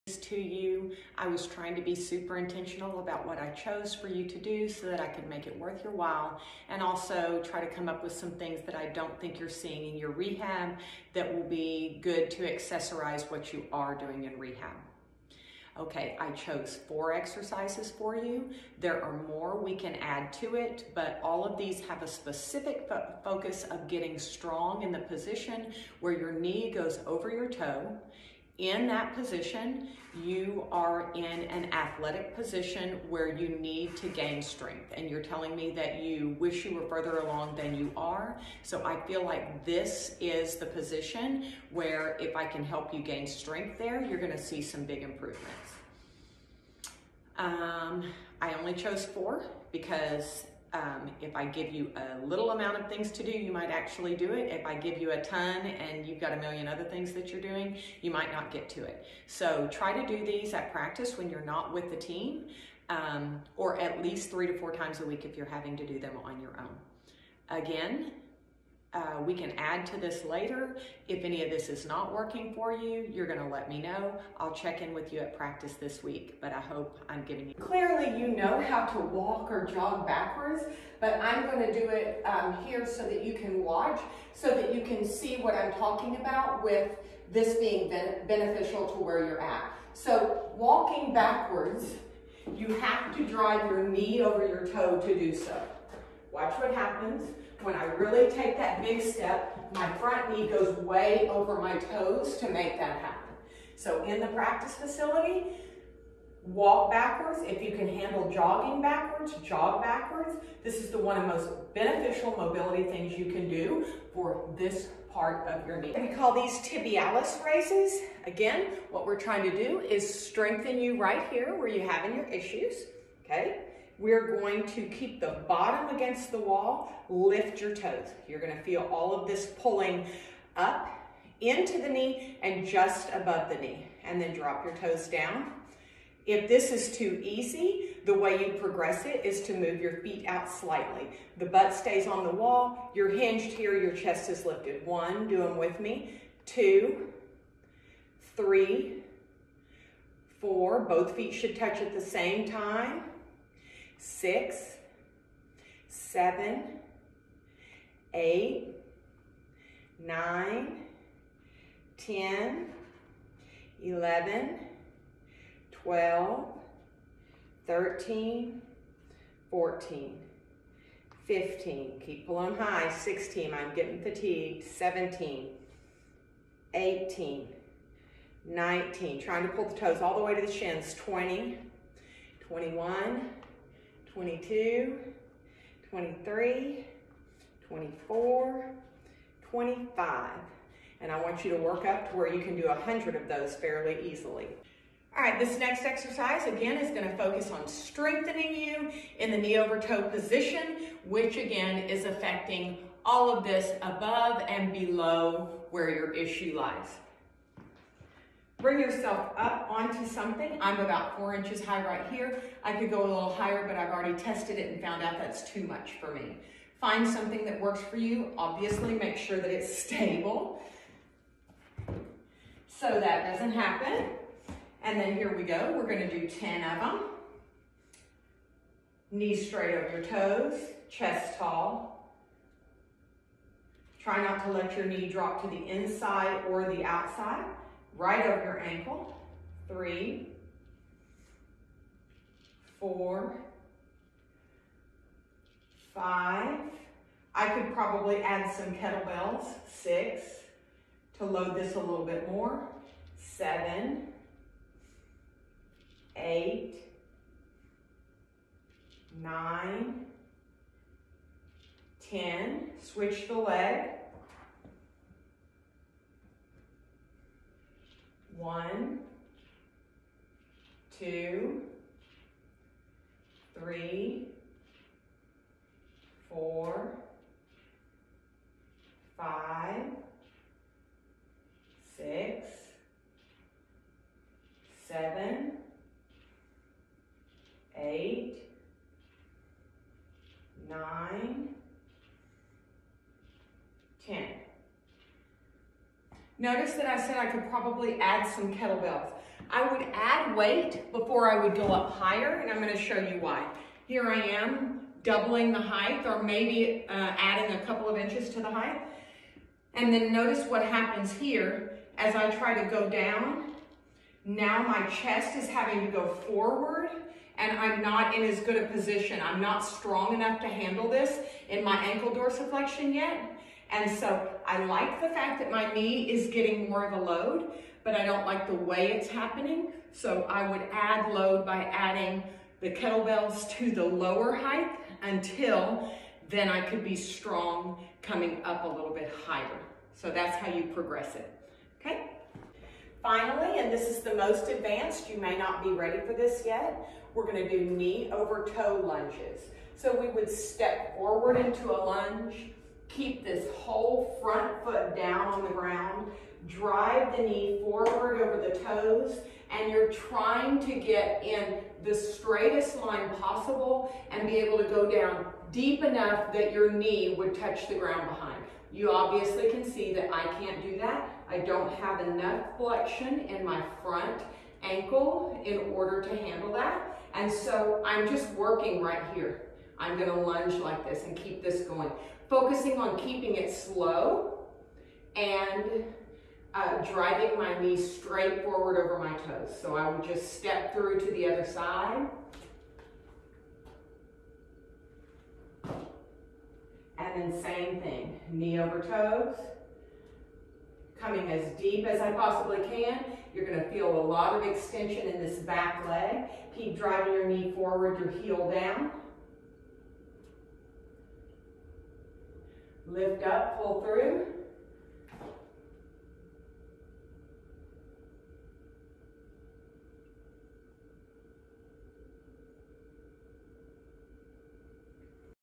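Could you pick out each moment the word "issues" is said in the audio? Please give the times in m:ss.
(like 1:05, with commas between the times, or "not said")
2:02, 3:26.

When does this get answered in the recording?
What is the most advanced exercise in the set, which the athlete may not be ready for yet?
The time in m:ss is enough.
5:47.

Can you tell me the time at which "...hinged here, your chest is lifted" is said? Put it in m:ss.
2:23.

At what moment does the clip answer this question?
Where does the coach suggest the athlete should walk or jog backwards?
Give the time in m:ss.
1:44.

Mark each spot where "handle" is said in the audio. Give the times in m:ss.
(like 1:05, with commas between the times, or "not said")
1:47, 5:20, 6:16.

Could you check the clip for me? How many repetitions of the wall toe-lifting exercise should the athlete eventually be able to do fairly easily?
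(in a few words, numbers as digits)
100.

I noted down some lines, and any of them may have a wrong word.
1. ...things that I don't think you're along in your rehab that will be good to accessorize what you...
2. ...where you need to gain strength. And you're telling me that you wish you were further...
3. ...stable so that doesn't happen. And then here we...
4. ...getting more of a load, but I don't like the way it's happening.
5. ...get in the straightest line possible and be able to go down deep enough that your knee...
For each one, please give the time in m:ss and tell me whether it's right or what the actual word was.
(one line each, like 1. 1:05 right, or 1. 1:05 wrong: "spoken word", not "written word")
1. 0:08 wrong: "seeing", not "along"
2. 0:33 right
3. 3:39 right
4. 5:26 right
5. 6:00 right.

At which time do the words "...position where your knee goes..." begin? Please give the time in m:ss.
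0:24.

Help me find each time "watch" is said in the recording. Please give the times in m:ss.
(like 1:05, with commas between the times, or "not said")
1:23, 1:36.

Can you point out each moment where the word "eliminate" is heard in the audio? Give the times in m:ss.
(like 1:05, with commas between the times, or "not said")
not said.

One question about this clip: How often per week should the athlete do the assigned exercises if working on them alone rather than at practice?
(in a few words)
3 to 4 times.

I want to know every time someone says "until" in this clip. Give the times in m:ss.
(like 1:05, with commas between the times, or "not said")
5:35.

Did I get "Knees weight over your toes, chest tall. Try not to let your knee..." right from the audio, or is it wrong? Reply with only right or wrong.
wrong.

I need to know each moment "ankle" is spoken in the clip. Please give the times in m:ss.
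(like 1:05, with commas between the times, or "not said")
3:58, 5:21, 6:14.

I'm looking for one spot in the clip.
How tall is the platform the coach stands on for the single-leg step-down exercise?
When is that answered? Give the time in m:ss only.
3:31.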